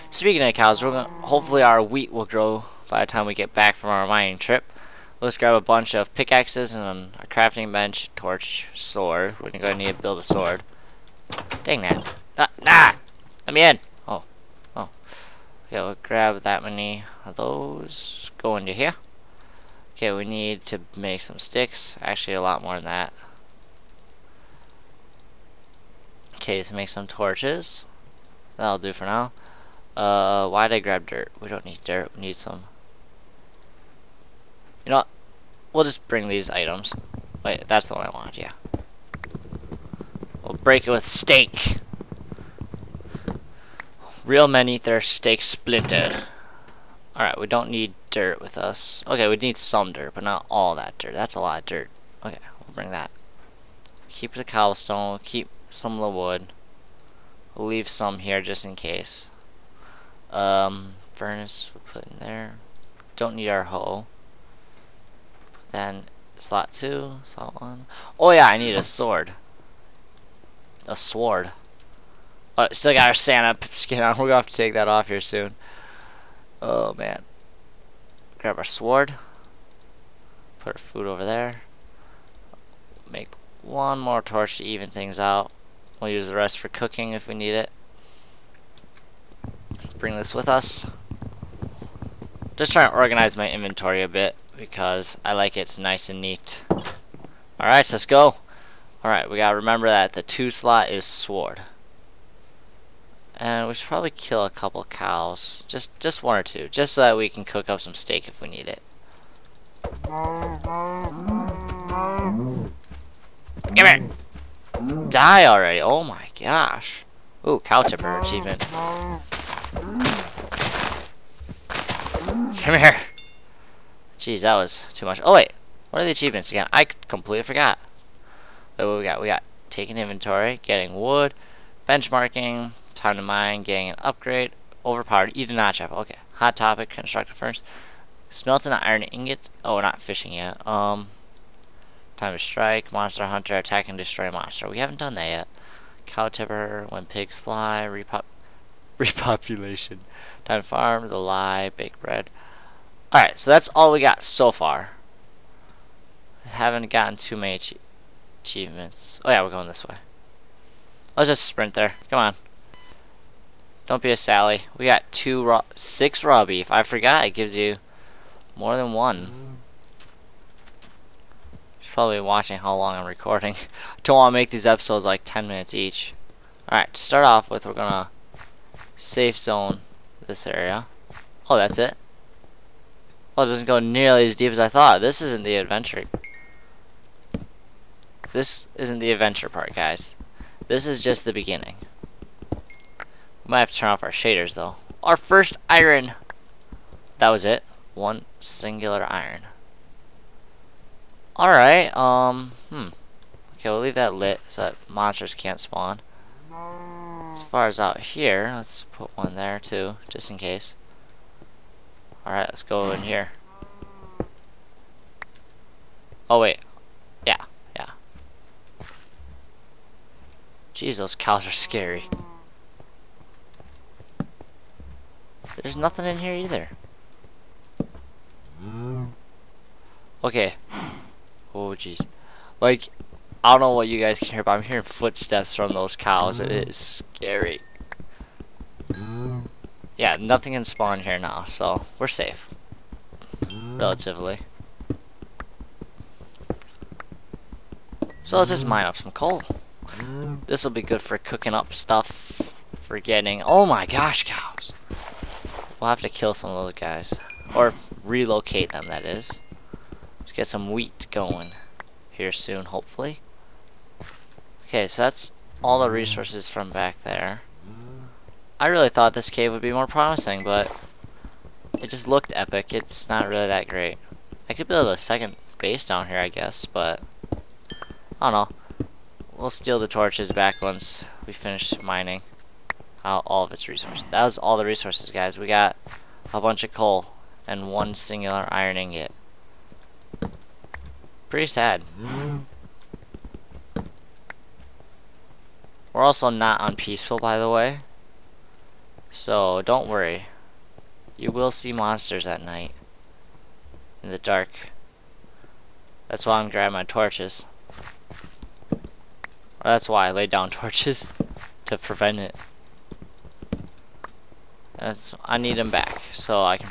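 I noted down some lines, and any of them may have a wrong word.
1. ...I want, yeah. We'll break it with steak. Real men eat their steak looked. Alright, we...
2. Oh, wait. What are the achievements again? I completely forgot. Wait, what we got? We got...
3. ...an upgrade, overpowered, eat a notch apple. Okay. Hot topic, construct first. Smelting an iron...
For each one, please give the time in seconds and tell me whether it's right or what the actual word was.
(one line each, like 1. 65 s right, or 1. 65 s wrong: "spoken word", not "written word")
1. 38 s wrong: "splintered", not "looked"
2. 125 s right
3. 133 s right.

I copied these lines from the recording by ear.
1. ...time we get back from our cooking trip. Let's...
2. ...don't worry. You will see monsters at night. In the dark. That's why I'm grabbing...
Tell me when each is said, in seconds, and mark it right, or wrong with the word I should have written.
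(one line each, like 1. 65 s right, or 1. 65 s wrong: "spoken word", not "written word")
1. 3 s wrong: "mining", not "cooking"
2. 299 s right.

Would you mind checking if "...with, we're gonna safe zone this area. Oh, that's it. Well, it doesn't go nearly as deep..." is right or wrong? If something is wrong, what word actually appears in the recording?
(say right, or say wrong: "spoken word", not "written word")
right.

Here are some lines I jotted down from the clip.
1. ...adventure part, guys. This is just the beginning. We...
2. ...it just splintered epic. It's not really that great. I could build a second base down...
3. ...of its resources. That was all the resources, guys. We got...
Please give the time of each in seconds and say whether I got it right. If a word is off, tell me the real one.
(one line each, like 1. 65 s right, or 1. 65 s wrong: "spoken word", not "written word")
1. 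189 s right
2. 271 s wrong: "looked", not "splintered"
3. 283 s right.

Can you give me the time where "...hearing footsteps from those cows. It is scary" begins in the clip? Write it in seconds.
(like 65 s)
234 s.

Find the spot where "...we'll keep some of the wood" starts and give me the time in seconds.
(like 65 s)
55 s.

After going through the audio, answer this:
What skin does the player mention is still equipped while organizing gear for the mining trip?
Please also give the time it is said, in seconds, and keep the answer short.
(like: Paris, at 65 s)
Santa skin, at 73 s.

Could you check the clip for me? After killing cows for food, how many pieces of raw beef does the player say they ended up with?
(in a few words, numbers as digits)
6.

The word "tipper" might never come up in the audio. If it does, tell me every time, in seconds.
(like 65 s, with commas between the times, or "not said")
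117 s, 146 s.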